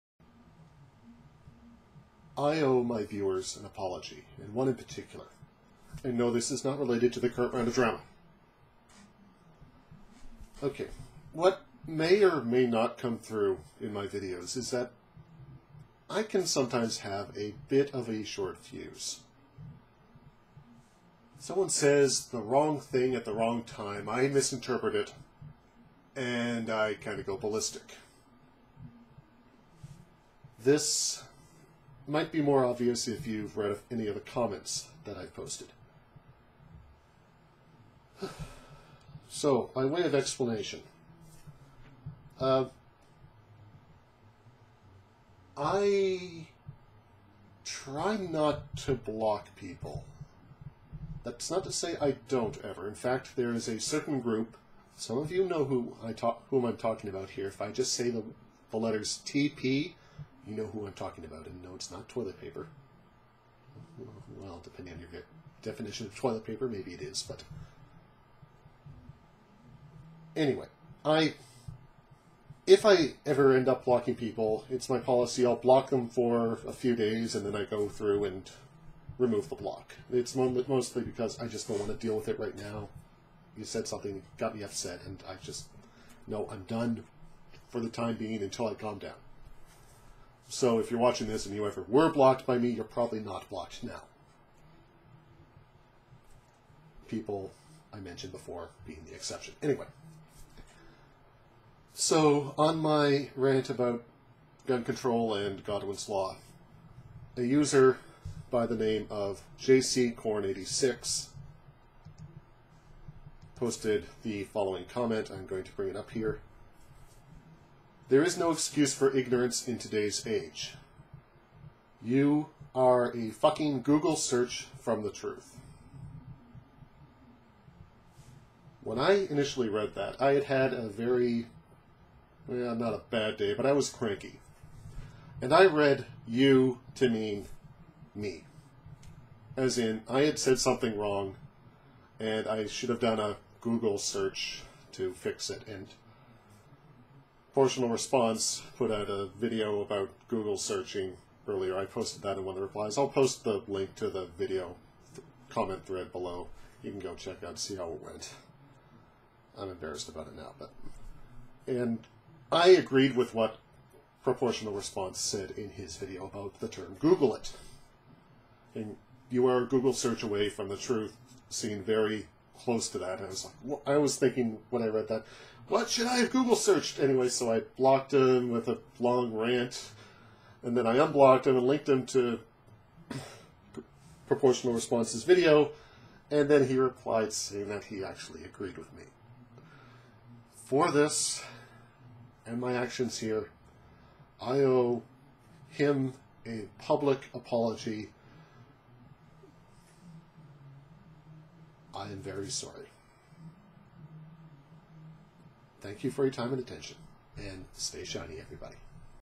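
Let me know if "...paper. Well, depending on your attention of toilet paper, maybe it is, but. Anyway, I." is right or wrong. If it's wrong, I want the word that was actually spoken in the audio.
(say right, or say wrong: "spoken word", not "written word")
wrong: "definition", not "attention".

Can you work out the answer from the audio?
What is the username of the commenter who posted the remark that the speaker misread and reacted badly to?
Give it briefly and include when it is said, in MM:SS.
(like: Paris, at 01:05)
JC Korn86, at 01:49.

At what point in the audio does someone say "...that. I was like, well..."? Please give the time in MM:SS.
02:52.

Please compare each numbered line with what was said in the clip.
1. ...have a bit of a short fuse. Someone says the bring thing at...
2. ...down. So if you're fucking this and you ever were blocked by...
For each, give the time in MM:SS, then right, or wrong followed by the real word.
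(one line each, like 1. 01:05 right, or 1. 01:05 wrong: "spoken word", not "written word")
1. 00:16 wrong: "wrong", not "bring"
2. 01:28 wrong: "watching", not "fucking".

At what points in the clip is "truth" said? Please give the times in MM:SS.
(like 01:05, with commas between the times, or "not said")
02:05, 02:50.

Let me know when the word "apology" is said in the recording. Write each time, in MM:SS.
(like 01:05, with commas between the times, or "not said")
00:03, 03:17.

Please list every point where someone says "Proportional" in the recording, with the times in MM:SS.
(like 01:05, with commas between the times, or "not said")
02:27, 02:44, 03:04.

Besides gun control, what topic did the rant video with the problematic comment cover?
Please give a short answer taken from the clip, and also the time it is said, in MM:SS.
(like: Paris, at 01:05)
Godwin's Law, at 01:45.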